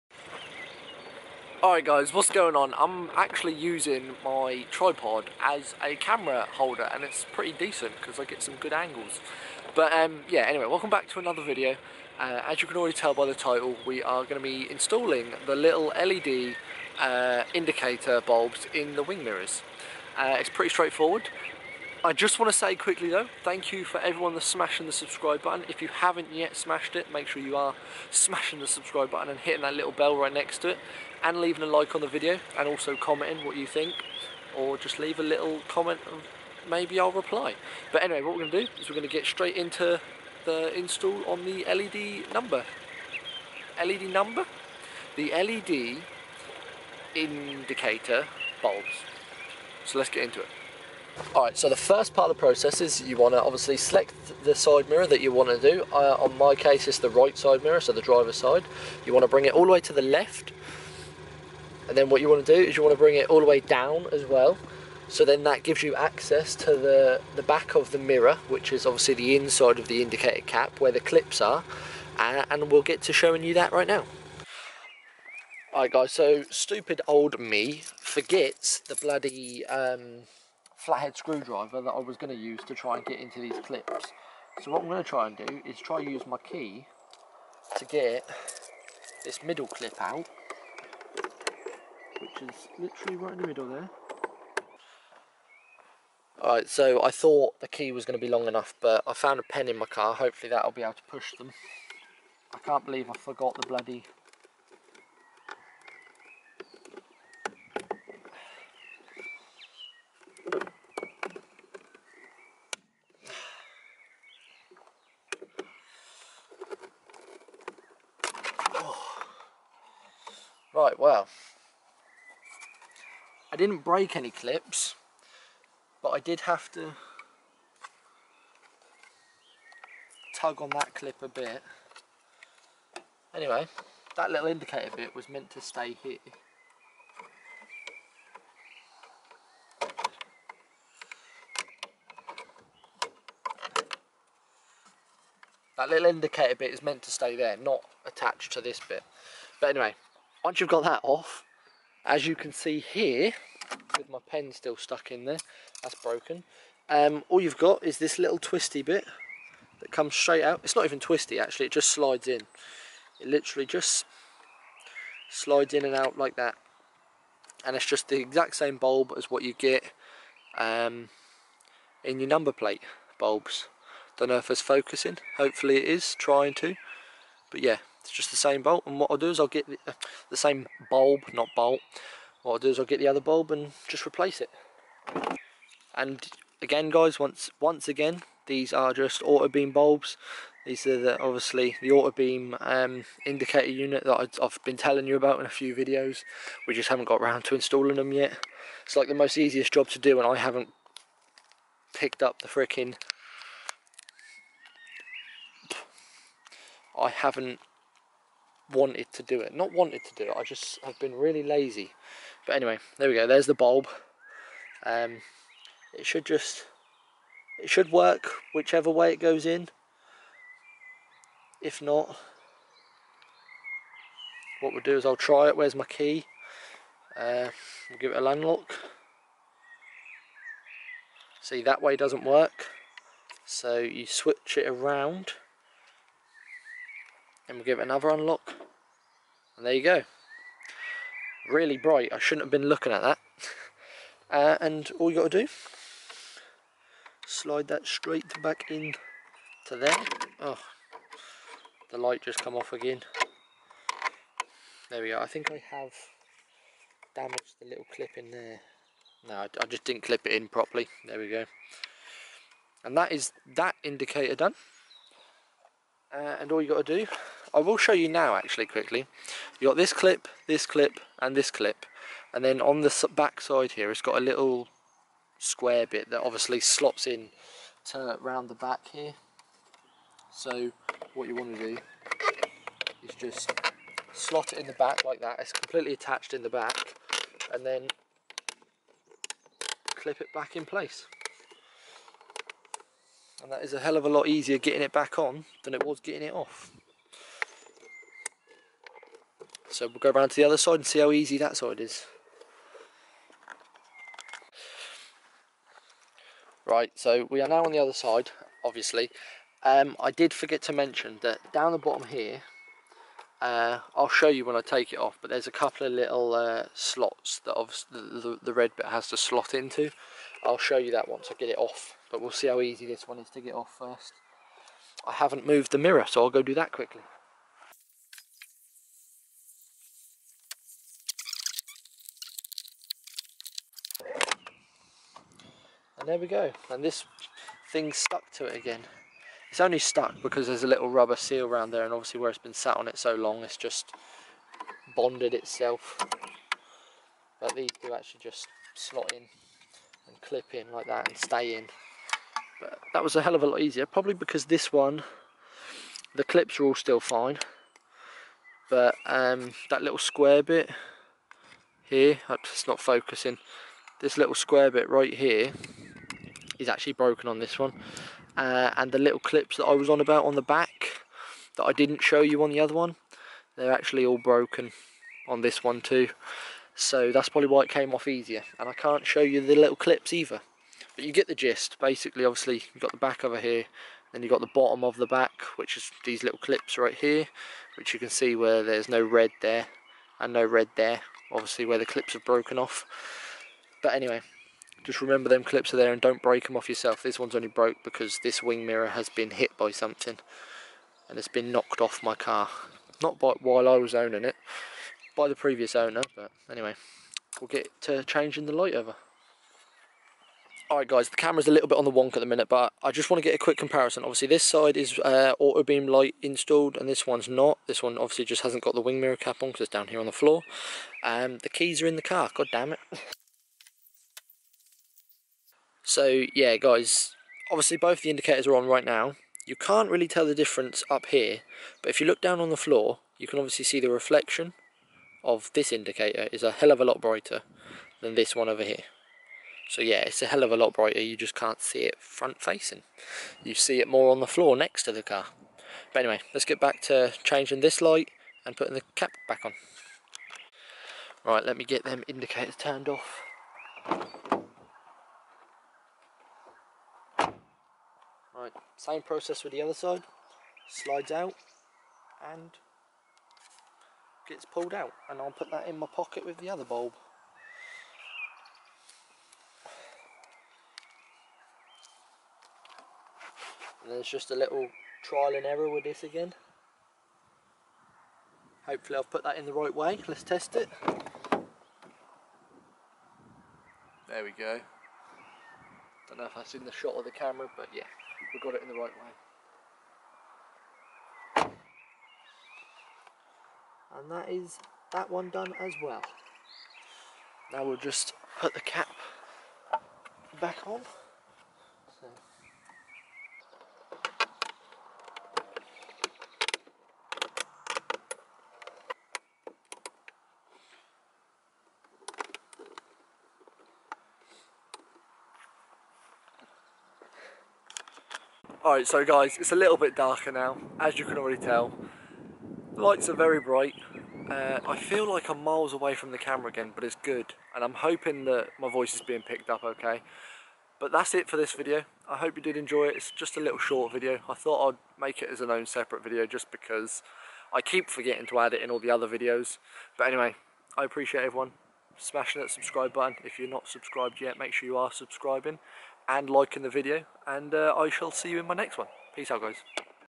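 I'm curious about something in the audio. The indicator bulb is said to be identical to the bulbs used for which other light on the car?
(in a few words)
Number plate bulbs.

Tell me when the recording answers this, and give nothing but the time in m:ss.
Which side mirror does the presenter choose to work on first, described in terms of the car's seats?
0:57.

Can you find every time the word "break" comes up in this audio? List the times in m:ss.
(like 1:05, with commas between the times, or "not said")
2:03, 6:36.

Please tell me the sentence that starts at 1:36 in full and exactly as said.
Alright, so I thought the key was going to be long enough, but I found a pen in my car.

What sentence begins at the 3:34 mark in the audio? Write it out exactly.
Um, it should just, it should work whichever way it goes in.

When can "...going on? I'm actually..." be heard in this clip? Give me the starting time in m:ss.
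0:02.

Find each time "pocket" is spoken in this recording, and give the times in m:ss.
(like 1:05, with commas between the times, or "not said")
7:45.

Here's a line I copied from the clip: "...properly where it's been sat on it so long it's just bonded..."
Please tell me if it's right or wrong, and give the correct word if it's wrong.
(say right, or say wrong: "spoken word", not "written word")
wrong: "obviously", not "properly".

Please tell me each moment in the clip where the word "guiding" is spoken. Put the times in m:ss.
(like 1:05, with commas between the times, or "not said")
not said.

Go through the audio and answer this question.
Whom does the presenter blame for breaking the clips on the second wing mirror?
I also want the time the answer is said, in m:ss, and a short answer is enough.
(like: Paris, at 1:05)
The previous owner, at 6:45.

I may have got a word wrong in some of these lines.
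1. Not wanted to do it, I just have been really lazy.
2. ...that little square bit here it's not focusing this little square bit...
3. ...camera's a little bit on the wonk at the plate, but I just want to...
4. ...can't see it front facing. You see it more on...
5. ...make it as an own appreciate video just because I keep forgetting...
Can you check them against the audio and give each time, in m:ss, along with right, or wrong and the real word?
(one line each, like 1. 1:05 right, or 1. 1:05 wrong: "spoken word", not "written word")
1. 3:29 right
2. 5:59 right
3. 6:51 wrong: "minute", not "plate"
4. 7:21 right
5. 8:55 wrong: "separate", not "appreciate".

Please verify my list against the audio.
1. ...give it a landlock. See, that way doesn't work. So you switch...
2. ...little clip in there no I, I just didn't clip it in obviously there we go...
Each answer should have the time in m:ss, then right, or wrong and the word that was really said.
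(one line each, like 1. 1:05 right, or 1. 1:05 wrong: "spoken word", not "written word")
1. 3:47 right
2. 4:17 wrong: "properly", not "obviously".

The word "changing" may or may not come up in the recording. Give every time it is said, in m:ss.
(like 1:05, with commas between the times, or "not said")
6:48, 7:27.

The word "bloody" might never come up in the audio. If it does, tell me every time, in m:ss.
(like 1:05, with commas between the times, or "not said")
1:18, 1:43.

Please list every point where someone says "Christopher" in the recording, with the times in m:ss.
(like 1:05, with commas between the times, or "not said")
not said.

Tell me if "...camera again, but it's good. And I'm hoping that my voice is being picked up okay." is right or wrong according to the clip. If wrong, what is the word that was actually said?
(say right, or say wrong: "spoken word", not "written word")
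right.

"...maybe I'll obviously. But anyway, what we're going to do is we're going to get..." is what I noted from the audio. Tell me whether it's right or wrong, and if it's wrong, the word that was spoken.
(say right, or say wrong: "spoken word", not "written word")
wrong: "reply", not "obviously".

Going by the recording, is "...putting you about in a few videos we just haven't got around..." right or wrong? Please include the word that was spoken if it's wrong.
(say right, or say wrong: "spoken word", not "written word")
wrong: "telling", not "putting".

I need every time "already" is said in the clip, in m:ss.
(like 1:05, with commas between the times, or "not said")
0:12, 8:41.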